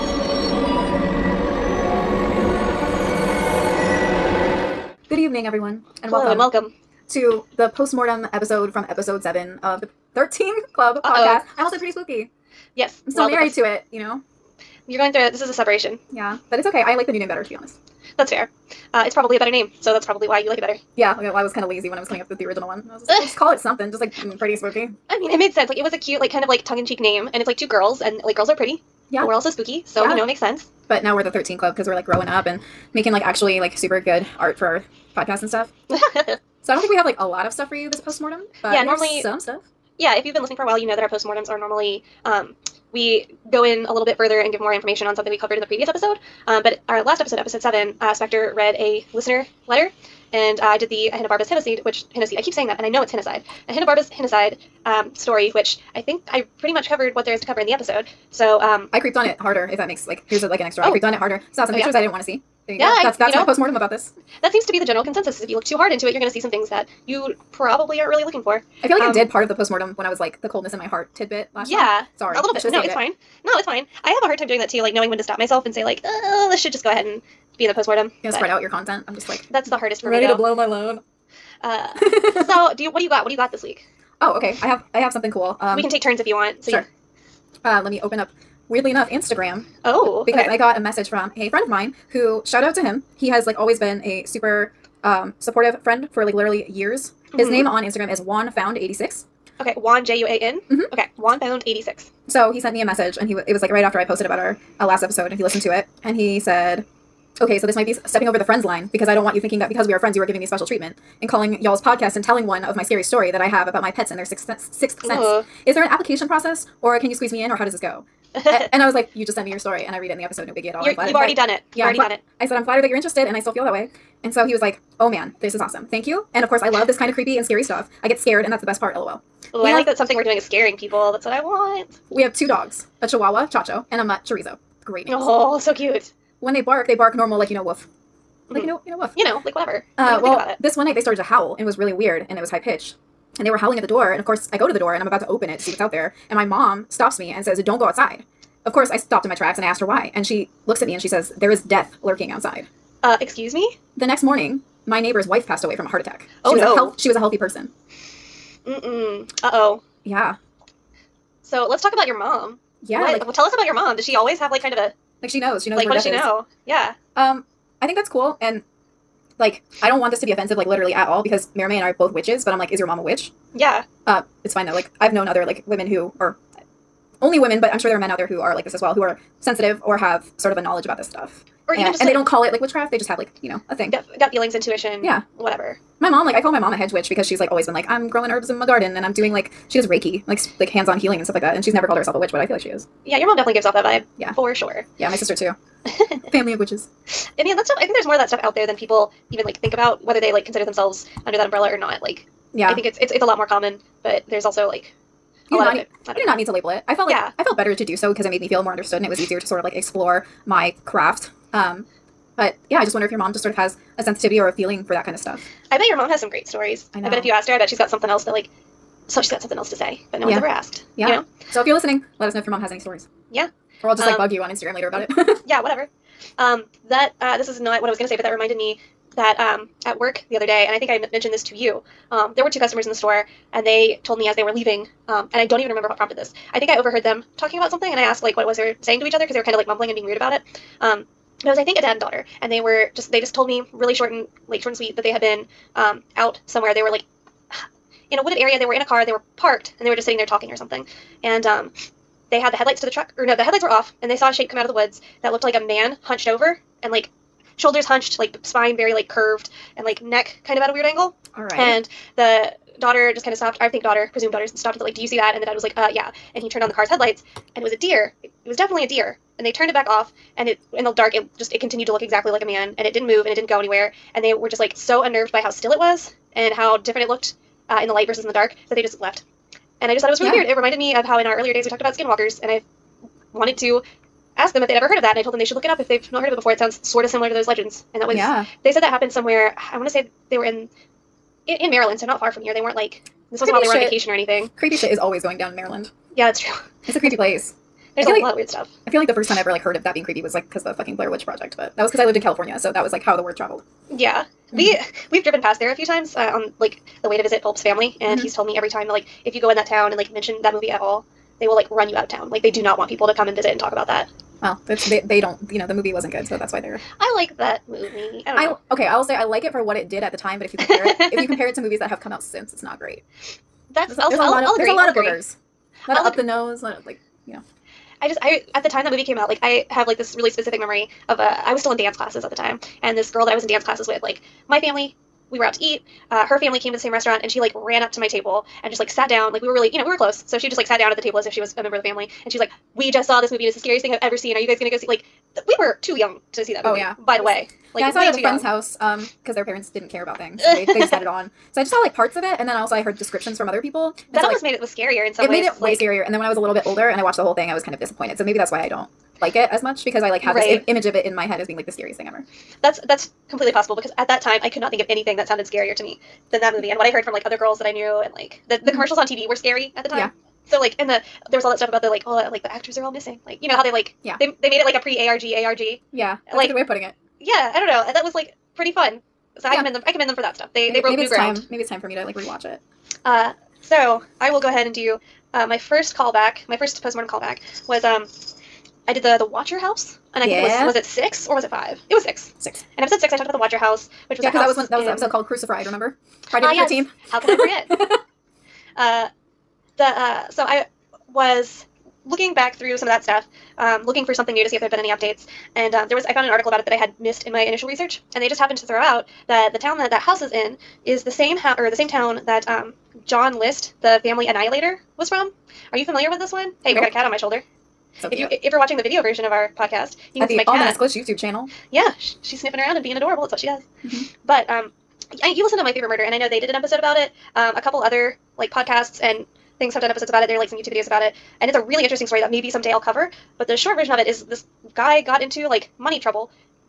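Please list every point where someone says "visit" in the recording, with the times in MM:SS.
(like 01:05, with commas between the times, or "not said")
05:07, 05:13.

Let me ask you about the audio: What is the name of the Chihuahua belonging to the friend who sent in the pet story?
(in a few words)
Chacho.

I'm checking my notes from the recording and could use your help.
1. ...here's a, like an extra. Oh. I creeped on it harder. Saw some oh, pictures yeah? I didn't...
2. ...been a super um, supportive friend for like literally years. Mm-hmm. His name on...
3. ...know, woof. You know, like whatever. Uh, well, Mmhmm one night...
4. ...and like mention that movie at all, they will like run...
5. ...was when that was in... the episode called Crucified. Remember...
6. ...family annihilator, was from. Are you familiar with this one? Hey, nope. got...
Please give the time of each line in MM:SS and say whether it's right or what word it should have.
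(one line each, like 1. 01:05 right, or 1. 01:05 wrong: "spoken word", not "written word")
1. 01:00 right
2. 01:33 right
3. 02:18 wrong: "This", not "Mmhmm"
4. 05:09 right
5. 06:34 right
6. 06:54 right.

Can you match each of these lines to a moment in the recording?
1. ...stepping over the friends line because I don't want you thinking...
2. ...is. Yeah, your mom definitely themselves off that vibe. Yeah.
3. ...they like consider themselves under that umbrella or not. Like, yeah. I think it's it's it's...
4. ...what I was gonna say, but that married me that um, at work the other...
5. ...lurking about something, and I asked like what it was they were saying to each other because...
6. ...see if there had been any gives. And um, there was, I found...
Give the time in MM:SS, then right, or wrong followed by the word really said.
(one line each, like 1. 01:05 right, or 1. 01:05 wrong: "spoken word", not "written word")
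1. 01:47 right
2. 03:12 wrong: "gives", not "themselves"
3. 03:20 right
4. 03:47 wrong: "reminded", not "married"
5. 03:57 wrong: "talking", not "lurking"
6. 06:44 wrong: "updates", not "gives".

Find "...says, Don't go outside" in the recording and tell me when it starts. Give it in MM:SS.
02:27.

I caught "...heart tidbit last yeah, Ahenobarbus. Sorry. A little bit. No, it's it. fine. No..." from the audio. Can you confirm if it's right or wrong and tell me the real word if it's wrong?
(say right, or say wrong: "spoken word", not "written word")
wrong: "Yeah", not "Ahenobarbus".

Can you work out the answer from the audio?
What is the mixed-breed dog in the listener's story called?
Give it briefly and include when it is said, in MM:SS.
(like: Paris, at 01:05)
Chorizo, at 02:14.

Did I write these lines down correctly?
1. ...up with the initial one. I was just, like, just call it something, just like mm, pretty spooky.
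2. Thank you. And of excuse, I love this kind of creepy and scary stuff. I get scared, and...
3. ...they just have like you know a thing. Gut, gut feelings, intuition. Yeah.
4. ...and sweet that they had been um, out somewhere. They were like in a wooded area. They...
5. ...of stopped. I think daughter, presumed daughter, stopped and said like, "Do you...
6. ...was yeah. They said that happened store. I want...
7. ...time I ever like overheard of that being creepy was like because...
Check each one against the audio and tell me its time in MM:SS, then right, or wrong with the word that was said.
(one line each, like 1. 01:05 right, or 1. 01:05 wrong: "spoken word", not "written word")
1. 00:22 wrong: "original", not "initial"
2. 02:05 wrong: "course", not "excuse"
3. 03:02 right
4. 04:04 right
5. 04:23 right
6. 04:48 wrong: "somewhere", not "store"
7. 04:59 wrong: "heard", not "overheard".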